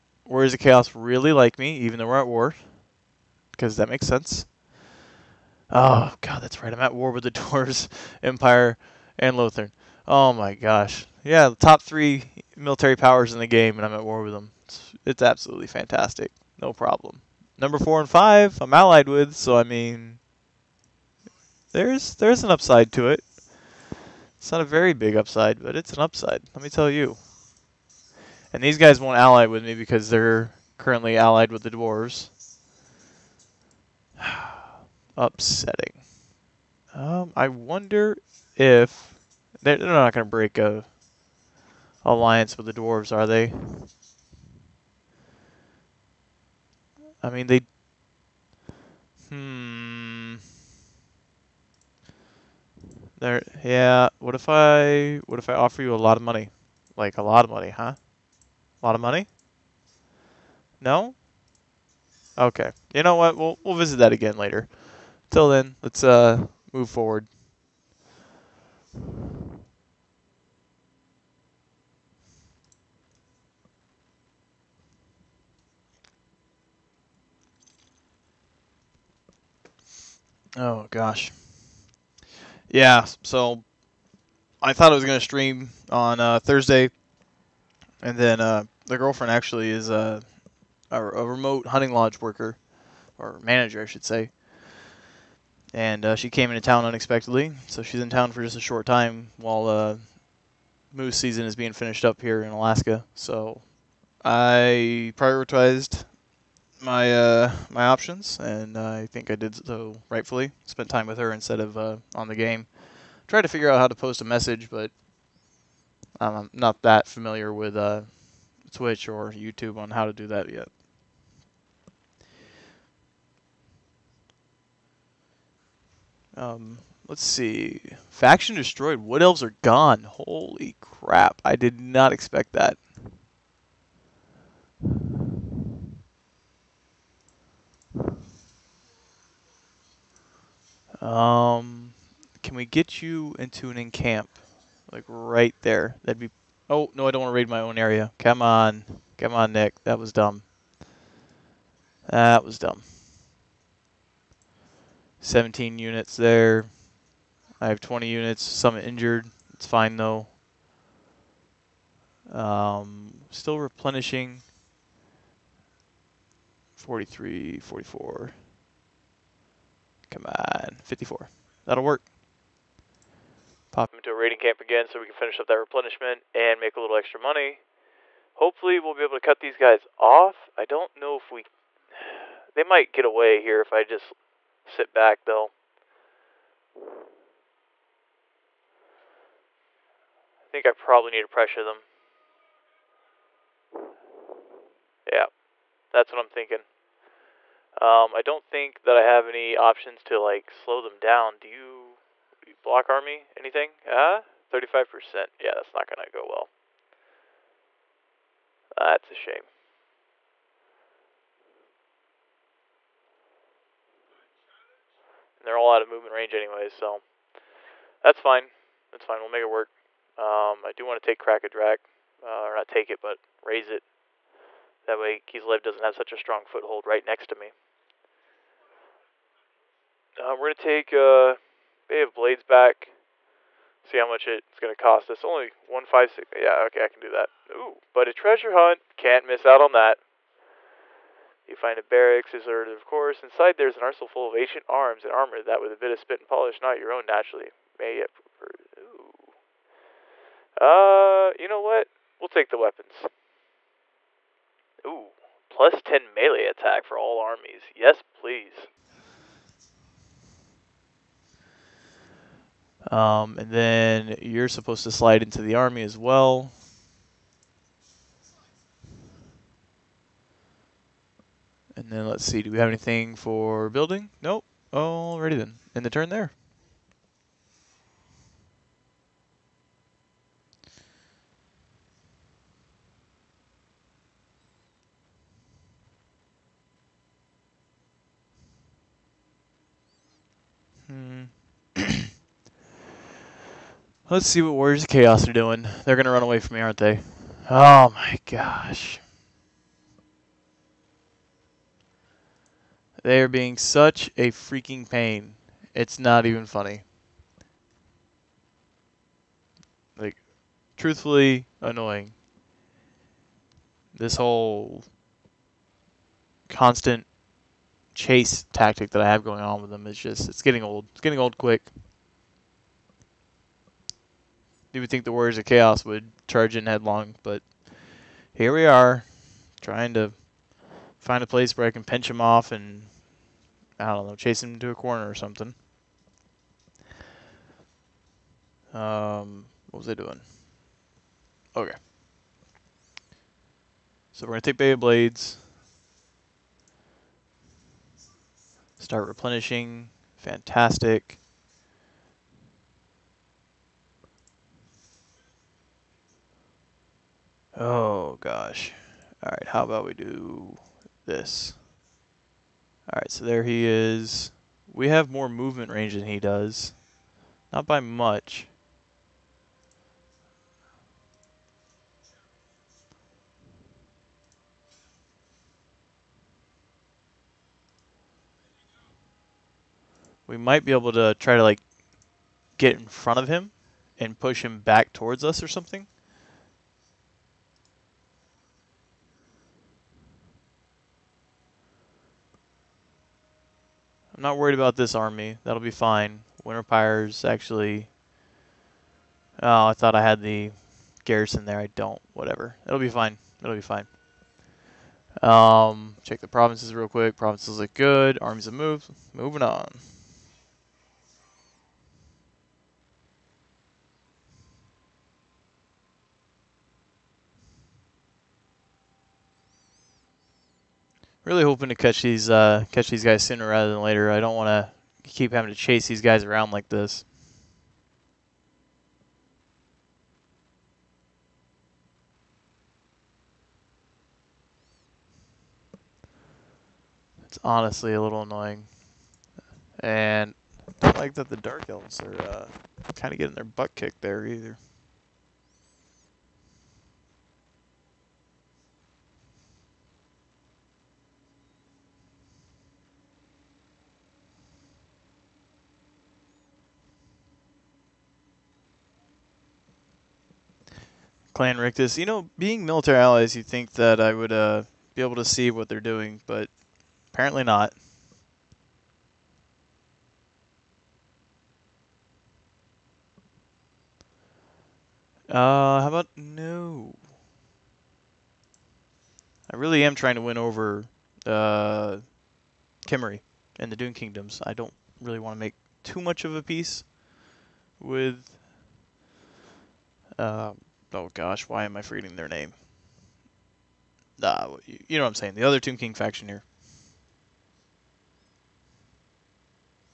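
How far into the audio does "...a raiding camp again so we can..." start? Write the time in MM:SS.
02:54.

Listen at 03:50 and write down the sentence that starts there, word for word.
Uh, we're going to take uh, Bay of Blades back.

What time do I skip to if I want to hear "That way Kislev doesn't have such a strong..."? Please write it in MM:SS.
03:44.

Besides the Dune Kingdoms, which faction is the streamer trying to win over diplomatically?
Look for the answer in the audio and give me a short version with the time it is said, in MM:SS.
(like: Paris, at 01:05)
Khemri, at 08:02.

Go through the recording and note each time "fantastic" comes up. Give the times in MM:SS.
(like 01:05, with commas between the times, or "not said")
00:15, 05:50.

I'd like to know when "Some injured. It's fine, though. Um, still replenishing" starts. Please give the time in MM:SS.
02:38.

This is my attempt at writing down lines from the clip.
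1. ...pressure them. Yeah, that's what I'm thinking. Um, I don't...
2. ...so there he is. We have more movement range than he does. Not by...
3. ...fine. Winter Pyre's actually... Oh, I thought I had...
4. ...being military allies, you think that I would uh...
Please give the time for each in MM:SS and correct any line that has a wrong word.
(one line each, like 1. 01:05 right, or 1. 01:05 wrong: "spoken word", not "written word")
1. 03:11 right
2. 06:03 right
3. 06:35 right
4. 07:42 right.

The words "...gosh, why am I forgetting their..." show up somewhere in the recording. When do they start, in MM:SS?
08:11.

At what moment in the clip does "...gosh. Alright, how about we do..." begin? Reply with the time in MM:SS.
05:58.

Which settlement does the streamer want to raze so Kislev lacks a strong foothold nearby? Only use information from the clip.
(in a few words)
Kraka Drak.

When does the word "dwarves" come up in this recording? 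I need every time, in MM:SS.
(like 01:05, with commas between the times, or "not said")
00:07, 00:31, 00:42.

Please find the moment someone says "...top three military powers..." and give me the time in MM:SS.
00:11.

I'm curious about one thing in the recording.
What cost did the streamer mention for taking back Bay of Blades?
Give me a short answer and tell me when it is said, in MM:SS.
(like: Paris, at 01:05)
156, at 03:55.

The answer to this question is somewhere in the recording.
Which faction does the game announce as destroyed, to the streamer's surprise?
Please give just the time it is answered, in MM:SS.
02:09.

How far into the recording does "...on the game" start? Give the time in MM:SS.
01:52.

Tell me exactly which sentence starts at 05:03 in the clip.
They are being such a freaking pain.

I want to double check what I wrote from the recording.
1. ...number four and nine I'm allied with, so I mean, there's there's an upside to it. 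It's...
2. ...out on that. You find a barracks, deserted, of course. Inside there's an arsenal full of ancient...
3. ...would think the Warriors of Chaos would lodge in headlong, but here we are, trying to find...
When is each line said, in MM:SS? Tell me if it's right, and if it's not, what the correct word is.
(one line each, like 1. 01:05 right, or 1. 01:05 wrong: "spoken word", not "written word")
1. 00:17 wrong: "five", not "nine"
2. 03:59 right
3. 05:24 wrong: "charge", not "lodge".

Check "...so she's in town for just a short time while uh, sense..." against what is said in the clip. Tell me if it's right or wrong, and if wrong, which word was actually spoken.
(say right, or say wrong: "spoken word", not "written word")
wrong: "moose", not "sense".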